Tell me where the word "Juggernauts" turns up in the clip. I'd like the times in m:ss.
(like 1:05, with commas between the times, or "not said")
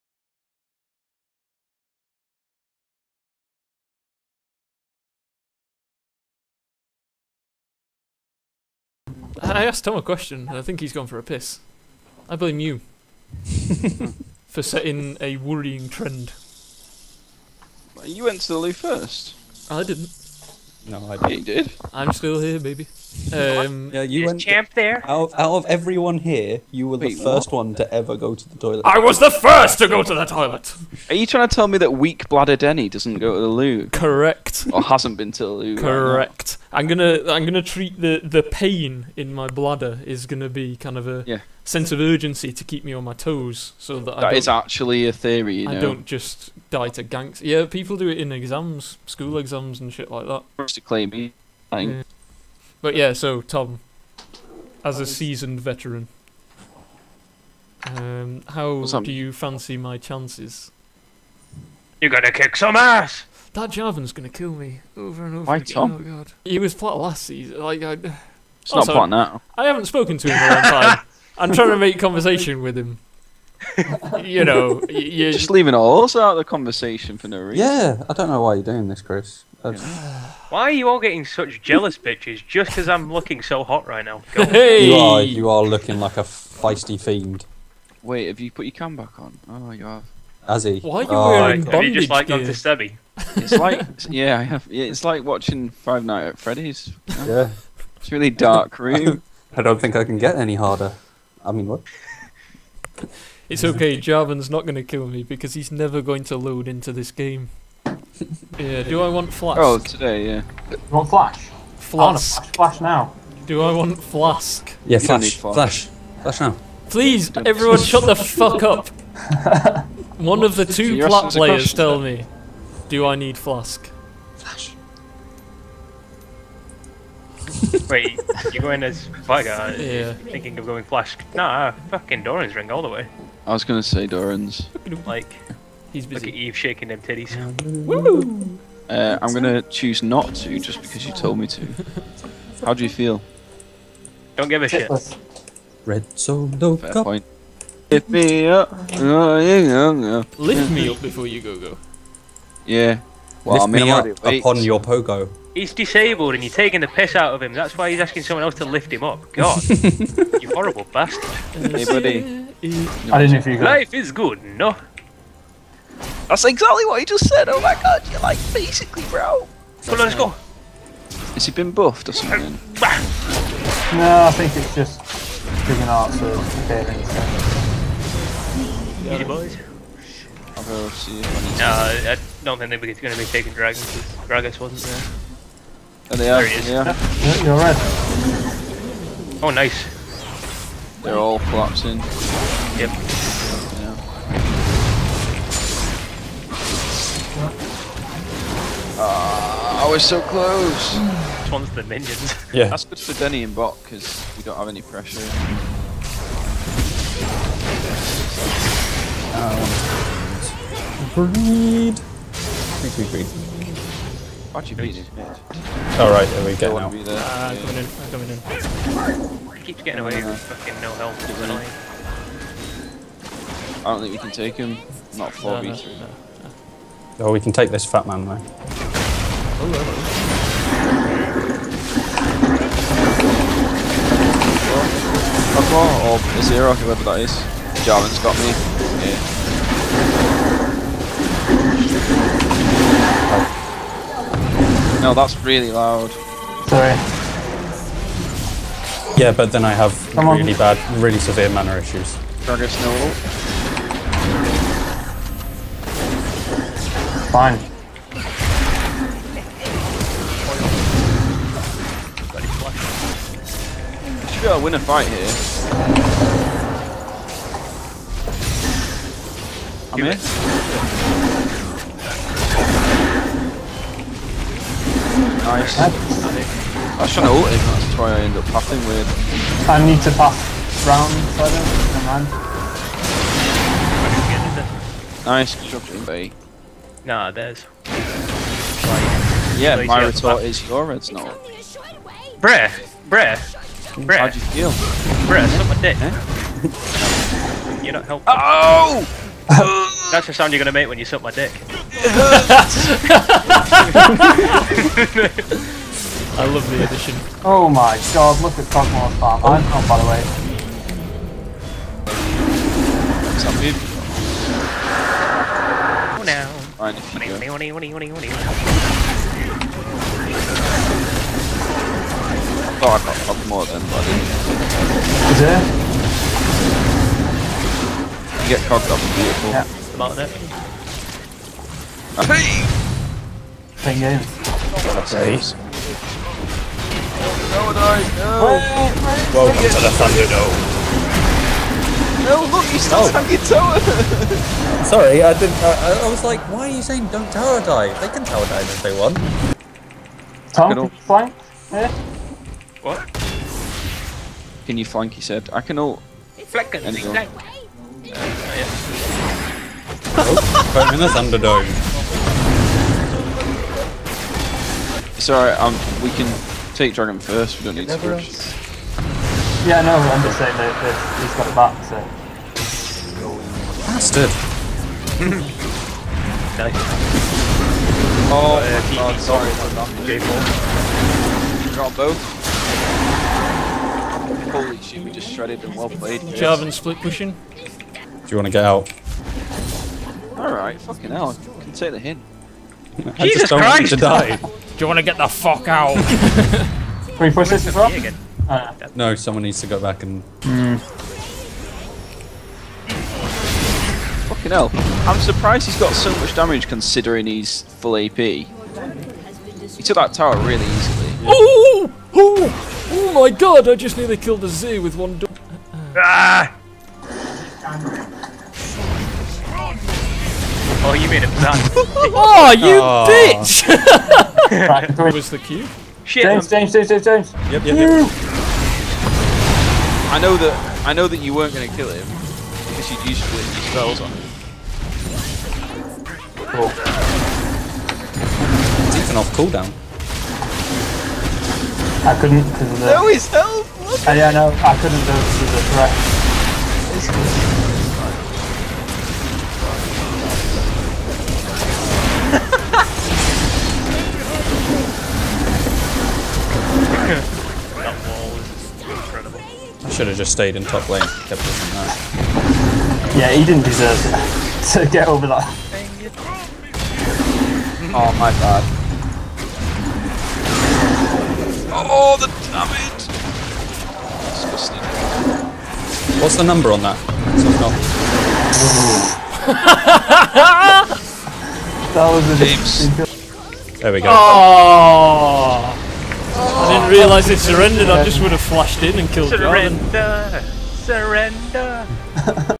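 2:55.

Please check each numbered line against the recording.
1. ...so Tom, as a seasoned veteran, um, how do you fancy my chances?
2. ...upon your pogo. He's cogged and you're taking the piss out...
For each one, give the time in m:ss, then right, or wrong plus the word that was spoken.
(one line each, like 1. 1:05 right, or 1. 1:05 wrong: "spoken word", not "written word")
1. 0:53 right
2. 2:34 wrong: "disabled", not "cogged".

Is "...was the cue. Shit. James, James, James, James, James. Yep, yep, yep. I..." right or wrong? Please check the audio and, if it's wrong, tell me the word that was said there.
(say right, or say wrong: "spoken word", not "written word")
right.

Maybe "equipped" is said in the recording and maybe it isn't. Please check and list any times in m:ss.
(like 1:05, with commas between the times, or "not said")
not said.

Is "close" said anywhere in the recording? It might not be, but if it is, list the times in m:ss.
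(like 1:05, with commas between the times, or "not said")
3:20.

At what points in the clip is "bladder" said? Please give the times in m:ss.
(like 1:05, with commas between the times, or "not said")
0:32, 0:39.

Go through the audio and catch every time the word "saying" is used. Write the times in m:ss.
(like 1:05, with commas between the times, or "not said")
5:46, 6:10.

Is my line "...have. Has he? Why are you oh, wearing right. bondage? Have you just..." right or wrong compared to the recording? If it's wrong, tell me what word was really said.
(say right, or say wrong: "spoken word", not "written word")
right.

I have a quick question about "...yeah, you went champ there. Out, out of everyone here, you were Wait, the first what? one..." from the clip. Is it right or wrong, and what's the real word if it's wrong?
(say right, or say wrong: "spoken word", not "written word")
right.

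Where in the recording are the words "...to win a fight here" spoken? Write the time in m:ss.
4:24.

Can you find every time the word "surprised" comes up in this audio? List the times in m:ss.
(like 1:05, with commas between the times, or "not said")
6:45.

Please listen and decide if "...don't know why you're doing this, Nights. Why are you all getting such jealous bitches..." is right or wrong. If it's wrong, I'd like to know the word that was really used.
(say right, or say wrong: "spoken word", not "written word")
wrong: "Chris", not "Nights".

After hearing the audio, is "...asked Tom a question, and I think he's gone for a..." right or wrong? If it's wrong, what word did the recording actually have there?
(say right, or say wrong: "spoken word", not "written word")
right.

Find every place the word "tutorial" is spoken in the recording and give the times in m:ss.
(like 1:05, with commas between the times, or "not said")
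not said.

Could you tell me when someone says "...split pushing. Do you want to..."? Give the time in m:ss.
6:26.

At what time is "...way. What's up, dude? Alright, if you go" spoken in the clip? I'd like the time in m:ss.
5:11.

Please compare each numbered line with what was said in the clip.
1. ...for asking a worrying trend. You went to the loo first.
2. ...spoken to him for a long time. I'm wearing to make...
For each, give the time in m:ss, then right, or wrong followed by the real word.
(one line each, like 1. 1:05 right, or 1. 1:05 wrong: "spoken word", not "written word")
1. 0:14 wrong: "setting", not "asking"
2. 1:09 wrong: "trying", not "wearing".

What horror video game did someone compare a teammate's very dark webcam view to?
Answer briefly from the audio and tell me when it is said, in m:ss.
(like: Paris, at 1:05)
Five Nights at Freddy's, at 1:35.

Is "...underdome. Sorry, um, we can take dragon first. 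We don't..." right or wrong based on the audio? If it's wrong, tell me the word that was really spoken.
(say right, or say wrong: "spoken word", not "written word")
right.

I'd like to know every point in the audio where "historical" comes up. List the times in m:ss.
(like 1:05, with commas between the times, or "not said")
not said.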